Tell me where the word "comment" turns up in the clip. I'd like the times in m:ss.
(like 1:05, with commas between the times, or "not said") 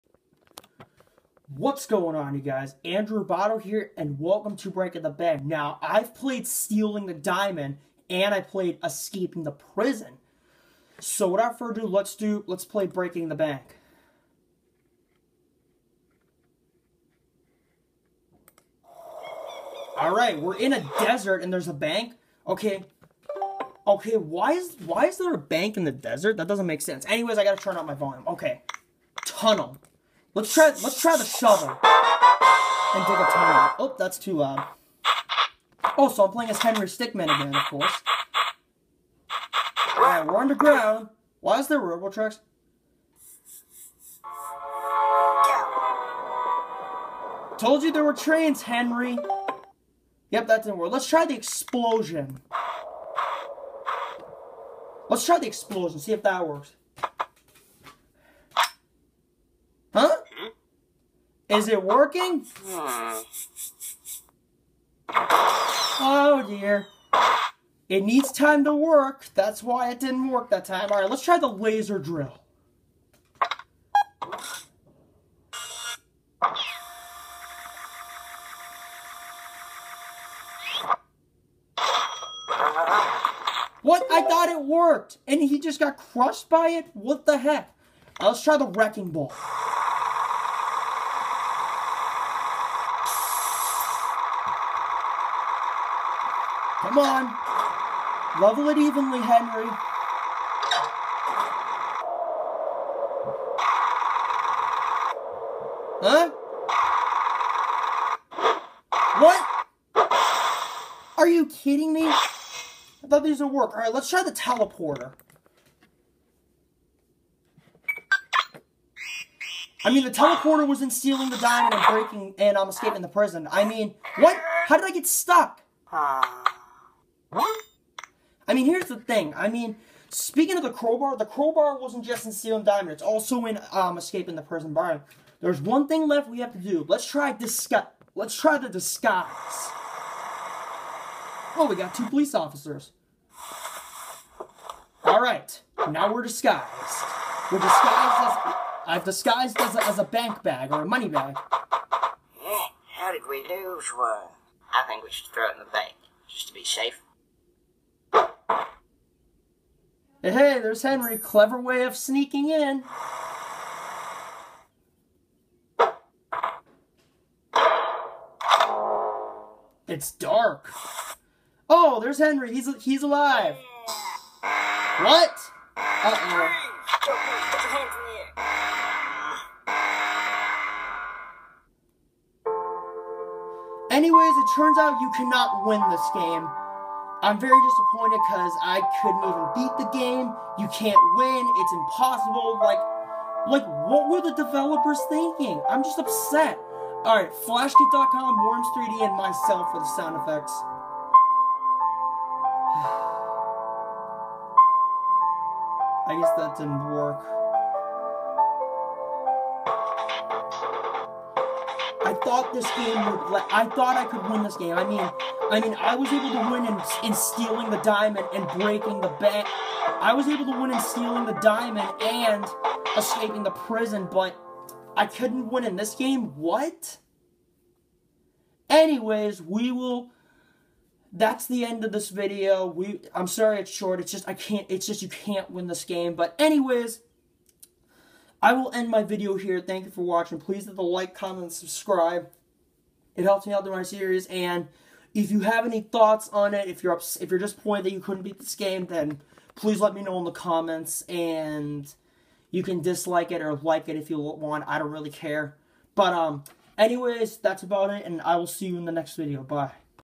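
4:01, 4:10.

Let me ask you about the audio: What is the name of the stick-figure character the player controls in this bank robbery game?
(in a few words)
Henry Stickman.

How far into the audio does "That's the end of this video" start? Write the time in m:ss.
3:51.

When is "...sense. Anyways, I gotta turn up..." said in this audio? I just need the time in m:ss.
0:26.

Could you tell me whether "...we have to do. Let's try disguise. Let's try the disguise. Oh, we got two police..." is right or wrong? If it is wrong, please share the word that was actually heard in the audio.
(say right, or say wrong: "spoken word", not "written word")
right.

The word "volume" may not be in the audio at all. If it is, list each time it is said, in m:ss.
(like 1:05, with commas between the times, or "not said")
0:27.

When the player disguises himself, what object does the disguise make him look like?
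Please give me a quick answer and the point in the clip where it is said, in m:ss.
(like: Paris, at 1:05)
money bag, at 2:30.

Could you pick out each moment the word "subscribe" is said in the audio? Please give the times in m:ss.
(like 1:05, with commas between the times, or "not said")
4:01.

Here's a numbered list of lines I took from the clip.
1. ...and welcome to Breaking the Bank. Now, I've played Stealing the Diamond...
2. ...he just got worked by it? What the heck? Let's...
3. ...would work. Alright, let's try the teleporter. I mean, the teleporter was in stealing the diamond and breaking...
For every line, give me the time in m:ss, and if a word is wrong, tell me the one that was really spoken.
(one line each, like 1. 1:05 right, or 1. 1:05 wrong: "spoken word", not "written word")
1. 0:03 right
2. 1:25 wrong: "crushed", not "worked"
3. 1:53 right.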